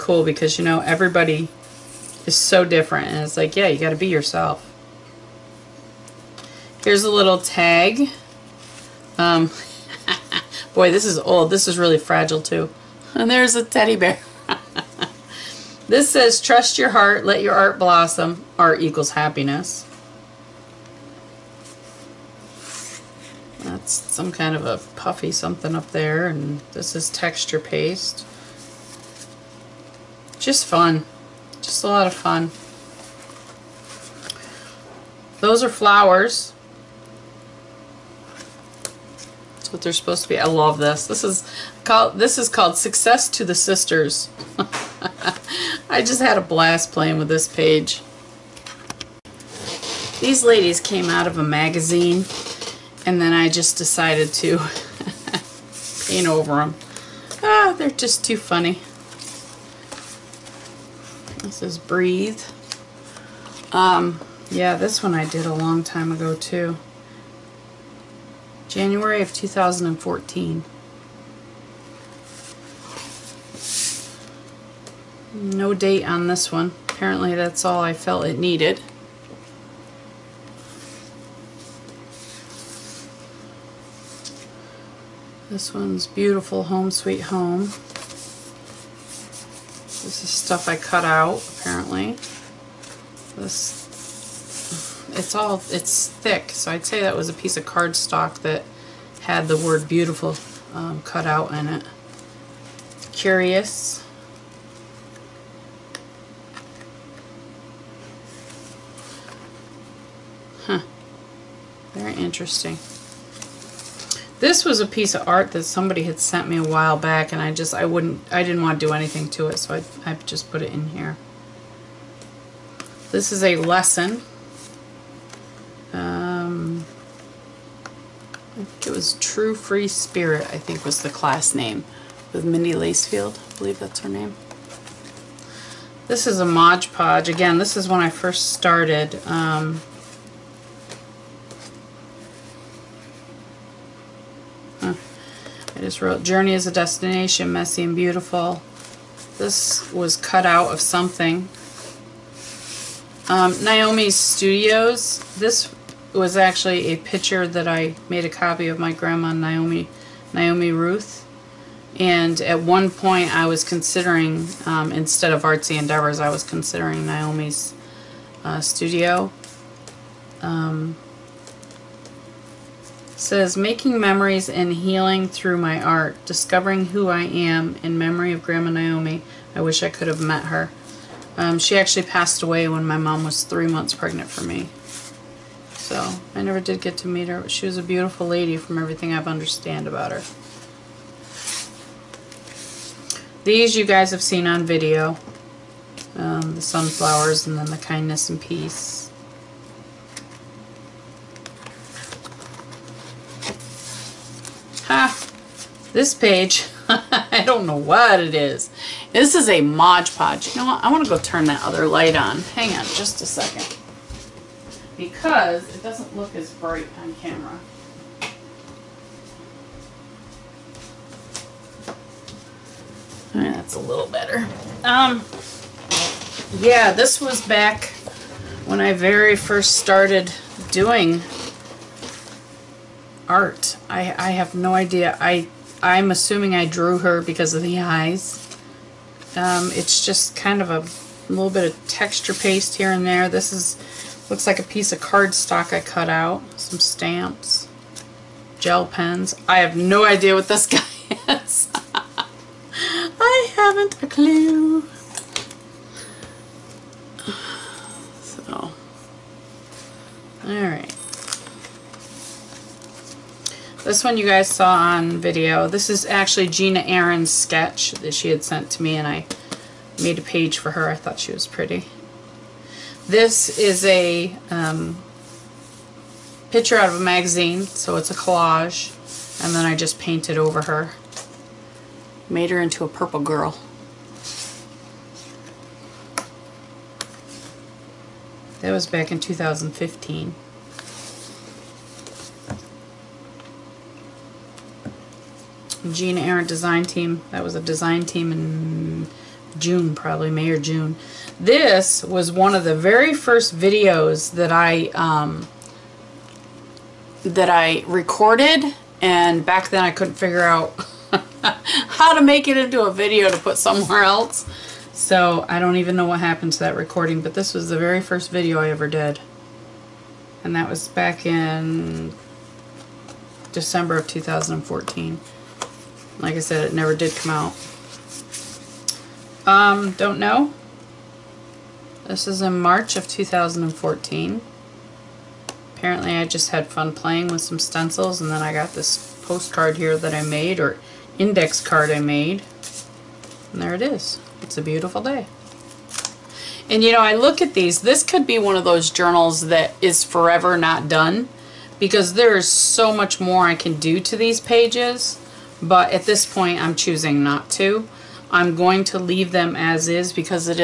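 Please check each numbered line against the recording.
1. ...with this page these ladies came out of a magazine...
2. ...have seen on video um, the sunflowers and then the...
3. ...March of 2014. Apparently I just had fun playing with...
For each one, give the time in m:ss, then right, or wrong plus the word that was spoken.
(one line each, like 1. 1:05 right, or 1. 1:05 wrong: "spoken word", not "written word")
1. 0:47 right
2. 3:14 right
3. 5:32 right.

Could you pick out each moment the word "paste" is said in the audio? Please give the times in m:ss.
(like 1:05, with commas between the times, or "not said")
0:27, 4:02.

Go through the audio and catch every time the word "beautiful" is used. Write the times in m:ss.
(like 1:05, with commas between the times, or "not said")
1:26, 1:39, 2:27, 3:07, 5:44.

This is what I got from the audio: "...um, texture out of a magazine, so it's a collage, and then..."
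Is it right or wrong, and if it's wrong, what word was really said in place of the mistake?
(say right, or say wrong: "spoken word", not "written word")
wrong: "picture", not "texture".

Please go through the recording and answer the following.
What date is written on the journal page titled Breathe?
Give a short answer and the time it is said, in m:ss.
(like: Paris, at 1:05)
January 2014, at 1:08.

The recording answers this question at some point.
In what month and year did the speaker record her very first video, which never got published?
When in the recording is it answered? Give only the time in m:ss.
5:23.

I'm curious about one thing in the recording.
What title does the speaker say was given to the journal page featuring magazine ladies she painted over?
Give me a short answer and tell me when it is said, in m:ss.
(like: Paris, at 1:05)
Success to the Sisters, at 0:42.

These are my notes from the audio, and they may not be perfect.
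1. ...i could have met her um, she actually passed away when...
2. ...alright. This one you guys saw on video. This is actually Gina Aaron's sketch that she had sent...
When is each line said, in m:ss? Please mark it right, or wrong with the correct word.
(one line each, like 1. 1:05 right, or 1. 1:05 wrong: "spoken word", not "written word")
1. 2:59 right
2. 4:20 right.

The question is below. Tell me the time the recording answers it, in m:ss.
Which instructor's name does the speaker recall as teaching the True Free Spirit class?
2:12.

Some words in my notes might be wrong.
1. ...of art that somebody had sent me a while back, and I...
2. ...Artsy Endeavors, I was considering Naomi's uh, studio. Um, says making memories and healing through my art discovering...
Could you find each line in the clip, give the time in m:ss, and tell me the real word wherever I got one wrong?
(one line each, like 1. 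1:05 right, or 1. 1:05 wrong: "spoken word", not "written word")
1. 1:55 right
2. 2:45 right.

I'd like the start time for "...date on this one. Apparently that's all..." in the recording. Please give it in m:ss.
1:15.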